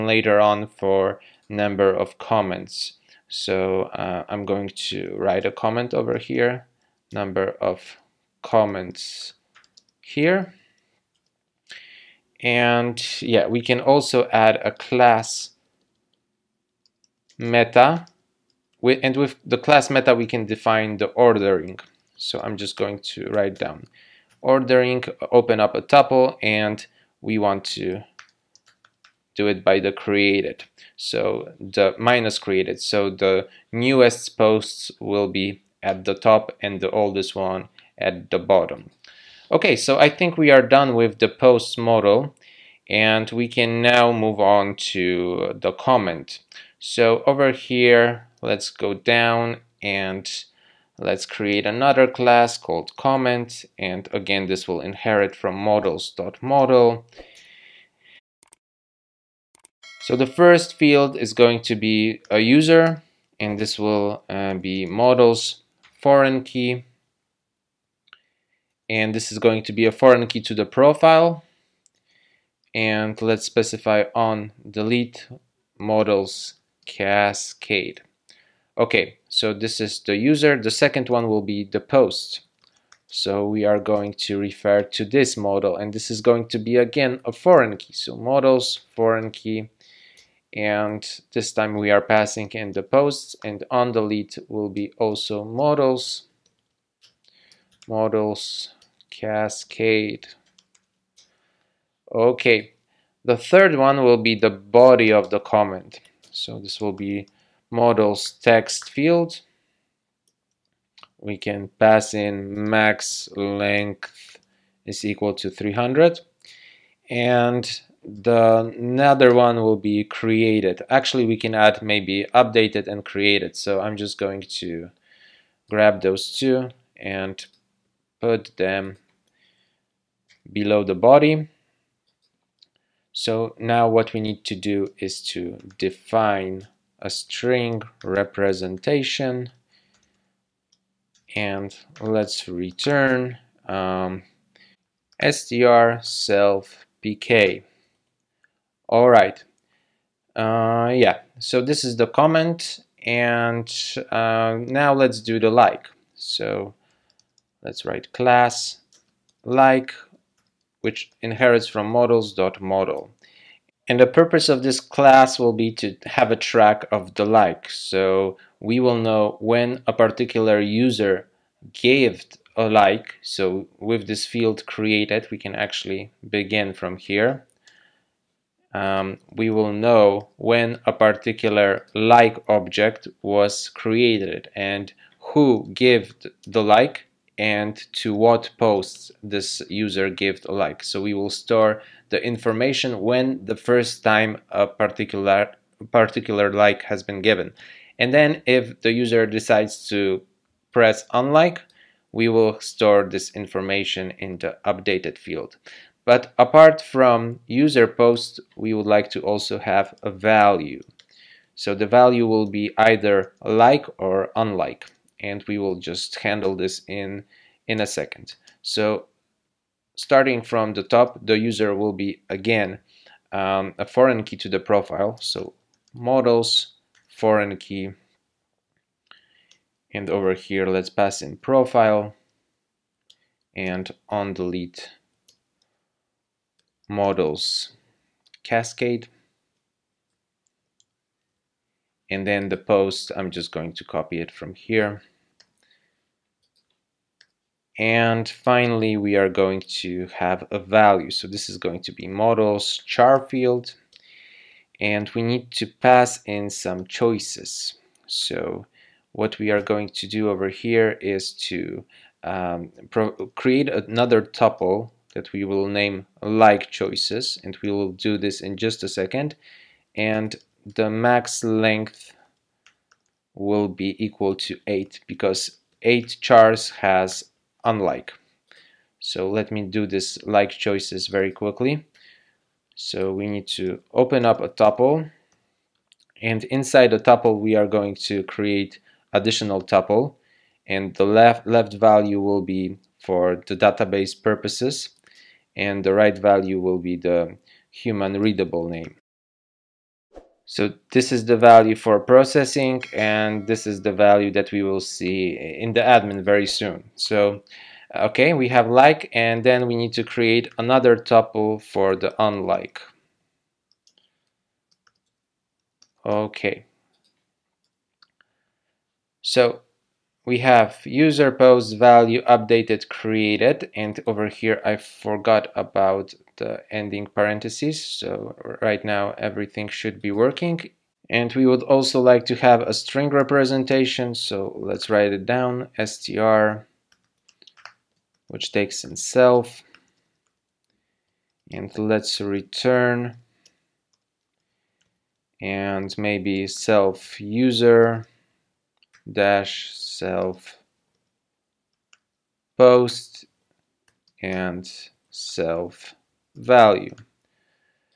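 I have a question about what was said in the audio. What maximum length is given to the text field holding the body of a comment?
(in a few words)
300.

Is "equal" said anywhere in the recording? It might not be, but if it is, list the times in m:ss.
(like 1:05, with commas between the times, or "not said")
1:55, 4:34.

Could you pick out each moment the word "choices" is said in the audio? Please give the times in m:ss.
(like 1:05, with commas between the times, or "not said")
4:16, 4:26, 4:40.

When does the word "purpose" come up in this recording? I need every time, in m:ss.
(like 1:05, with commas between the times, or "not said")
2:44, 4:54.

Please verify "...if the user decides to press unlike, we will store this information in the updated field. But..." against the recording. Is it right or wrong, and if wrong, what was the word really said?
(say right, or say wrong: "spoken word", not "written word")
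right.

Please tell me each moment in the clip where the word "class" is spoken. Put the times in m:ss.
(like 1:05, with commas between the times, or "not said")
0:14, 0:19, 0:52, 2:38, 2:44.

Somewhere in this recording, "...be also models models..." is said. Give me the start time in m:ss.
1:34.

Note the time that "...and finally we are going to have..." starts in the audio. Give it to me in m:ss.
4:07.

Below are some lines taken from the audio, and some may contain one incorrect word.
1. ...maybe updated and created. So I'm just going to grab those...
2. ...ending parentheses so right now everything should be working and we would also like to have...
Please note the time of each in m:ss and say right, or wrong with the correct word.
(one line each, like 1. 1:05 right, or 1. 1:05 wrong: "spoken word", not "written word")
1. 2:01 right
2. 5:26 right.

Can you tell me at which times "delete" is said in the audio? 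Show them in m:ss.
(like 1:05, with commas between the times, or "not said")
1:14, 1:33, 3:54.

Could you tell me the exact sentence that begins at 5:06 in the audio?
So okay, we have like and then we need to create another tuple for the unlike.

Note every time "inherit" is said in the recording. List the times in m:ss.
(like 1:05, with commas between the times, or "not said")
0:54, 2:41.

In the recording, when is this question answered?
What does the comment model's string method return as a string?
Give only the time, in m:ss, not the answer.
2:26.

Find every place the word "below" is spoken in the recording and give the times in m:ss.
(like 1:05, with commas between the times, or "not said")
2:10.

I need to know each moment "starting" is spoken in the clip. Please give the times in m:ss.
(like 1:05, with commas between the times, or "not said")
3:39.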